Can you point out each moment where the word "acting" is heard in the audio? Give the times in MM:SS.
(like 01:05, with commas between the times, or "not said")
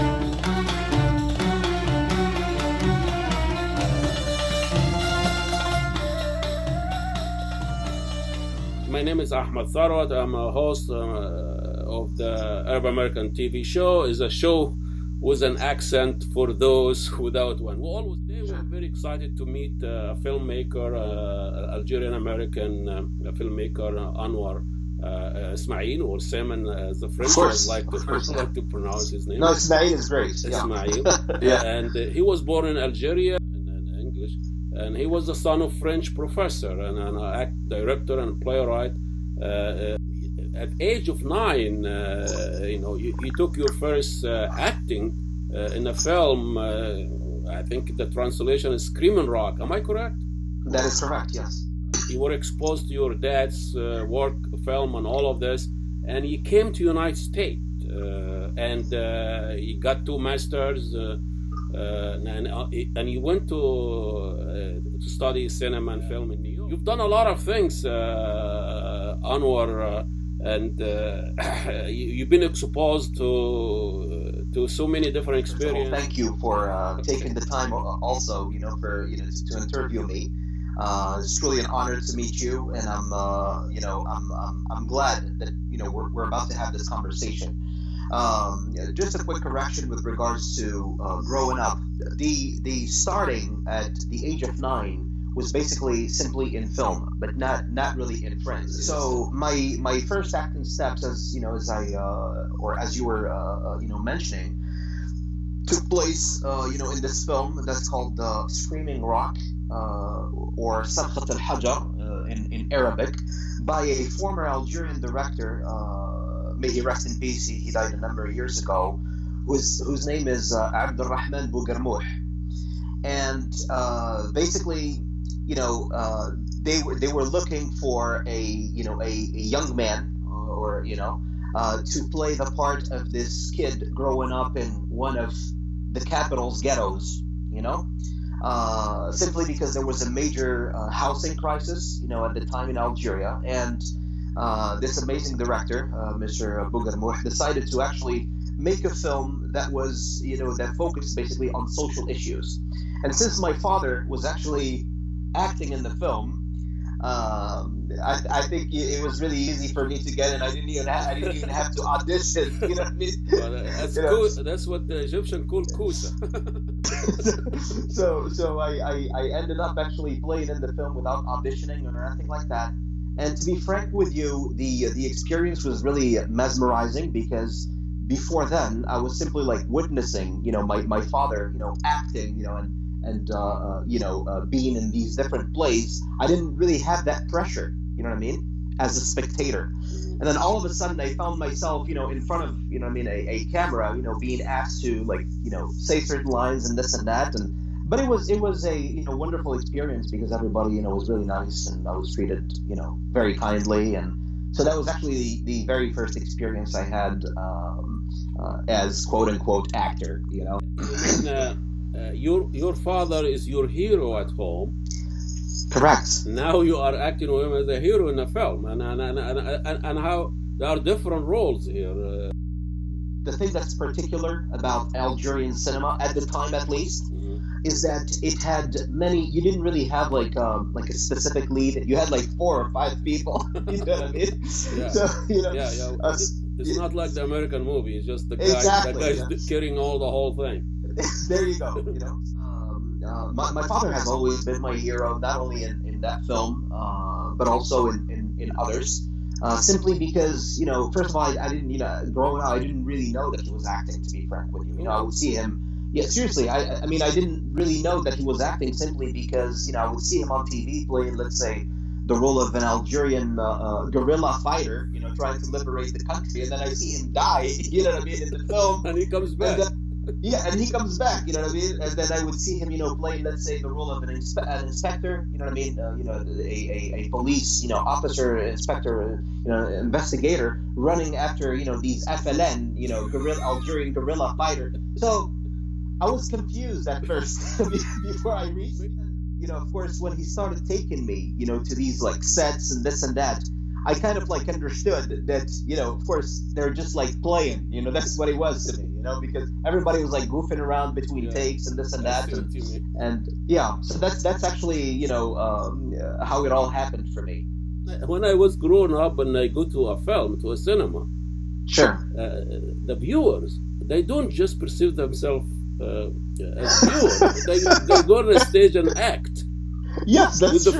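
00:44, 01:40, 02:35, 03:01, 03:36, 04:13, 04:18.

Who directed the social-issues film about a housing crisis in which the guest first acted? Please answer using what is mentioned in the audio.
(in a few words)
Abdurrahman Bouguermouh.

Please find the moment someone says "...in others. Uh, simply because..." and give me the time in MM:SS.
04:08.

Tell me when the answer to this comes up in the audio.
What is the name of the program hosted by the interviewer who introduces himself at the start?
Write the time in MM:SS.
00:12.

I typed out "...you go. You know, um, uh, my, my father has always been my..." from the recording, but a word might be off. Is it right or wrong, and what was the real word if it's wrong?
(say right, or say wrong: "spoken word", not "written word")
right.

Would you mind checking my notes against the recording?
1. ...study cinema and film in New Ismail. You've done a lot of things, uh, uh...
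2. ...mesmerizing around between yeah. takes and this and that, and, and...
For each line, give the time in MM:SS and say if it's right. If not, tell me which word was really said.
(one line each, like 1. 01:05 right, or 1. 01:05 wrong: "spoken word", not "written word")
1. 01:05 wrong: "York", not "Ismail"
2. 05:00 wrong: "goofing", not "mesmerizing".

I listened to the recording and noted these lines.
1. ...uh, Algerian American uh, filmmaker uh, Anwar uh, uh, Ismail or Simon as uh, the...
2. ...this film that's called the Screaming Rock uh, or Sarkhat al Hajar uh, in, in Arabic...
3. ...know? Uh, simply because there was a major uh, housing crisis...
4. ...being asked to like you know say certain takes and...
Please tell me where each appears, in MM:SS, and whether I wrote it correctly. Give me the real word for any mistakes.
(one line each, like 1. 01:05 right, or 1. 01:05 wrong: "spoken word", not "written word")
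1. 00:20 right
2. 01:47 right
3. 02:17 right
4. 03:14 wrong: "lines", not "takes".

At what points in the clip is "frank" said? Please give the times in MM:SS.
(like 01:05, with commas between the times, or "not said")
02:53, 04:14.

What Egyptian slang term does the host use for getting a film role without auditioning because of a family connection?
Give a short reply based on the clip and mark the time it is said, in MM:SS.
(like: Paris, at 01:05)
kusa, at 02:45.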